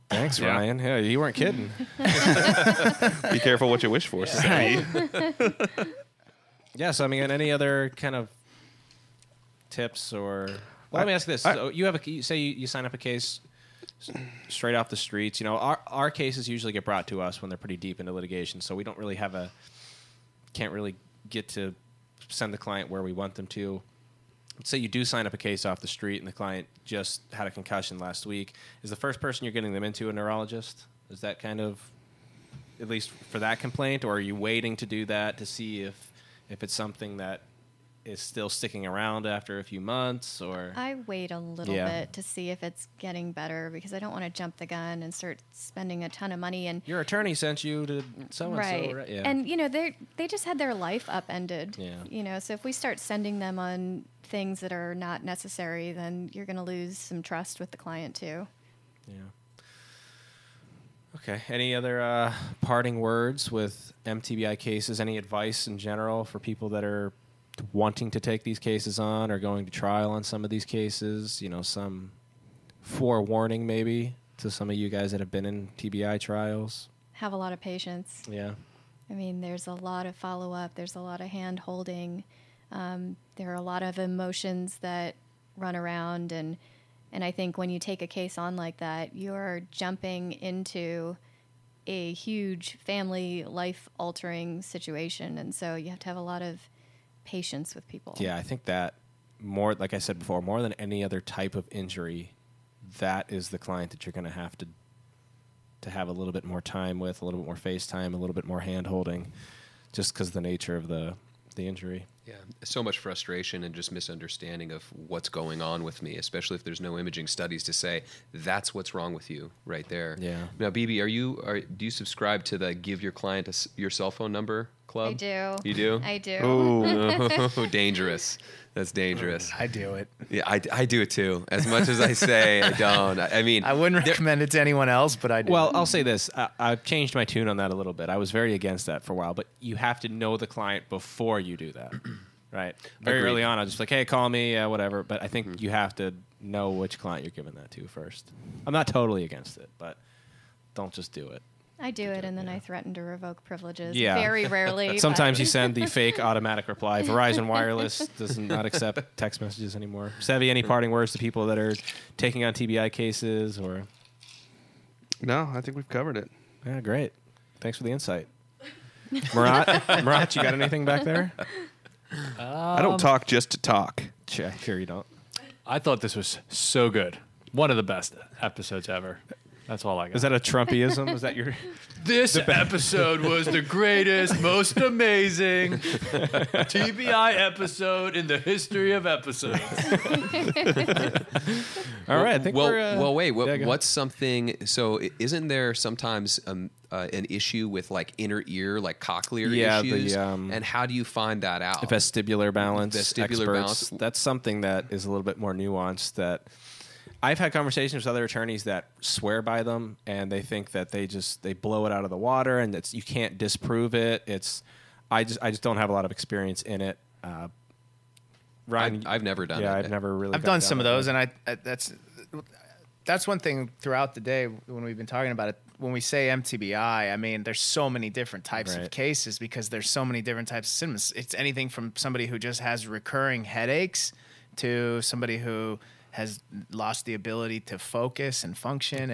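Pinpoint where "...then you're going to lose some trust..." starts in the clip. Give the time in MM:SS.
00:55.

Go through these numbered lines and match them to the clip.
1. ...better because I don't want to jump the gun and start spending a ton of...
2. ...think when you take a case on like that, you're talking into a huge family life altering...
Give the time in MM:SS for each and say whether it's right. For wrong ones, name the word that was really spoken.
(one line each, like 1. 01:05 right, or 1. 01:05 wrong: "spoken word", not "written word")
1. 00:43 right
2. 01:27 wrong: "jumping", not "talking".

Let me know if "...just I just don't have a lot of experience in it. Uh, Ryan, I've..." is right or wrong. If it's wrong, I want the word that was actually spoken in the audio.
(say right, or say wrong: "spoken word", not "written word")
right.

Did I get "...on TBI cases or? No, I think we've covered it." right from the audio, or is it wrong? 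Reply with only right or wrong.
right.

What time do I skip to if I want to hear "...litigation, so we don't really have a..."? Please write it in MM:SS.
00:18.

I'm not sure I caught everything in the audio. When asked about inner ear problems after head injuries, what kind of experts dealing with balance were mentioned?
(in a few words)
Vestibular experts.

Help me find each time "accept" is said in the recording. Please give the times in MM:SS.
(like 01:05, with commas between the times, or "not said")
02:38.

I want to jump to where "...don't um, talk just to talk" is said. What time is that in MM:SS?
02:52.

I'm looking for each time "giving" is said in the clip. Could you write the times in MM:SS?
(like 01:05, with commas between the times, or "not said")
02:27.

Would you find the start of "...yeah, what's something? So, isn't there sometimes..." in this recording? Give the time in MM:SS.
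03:13.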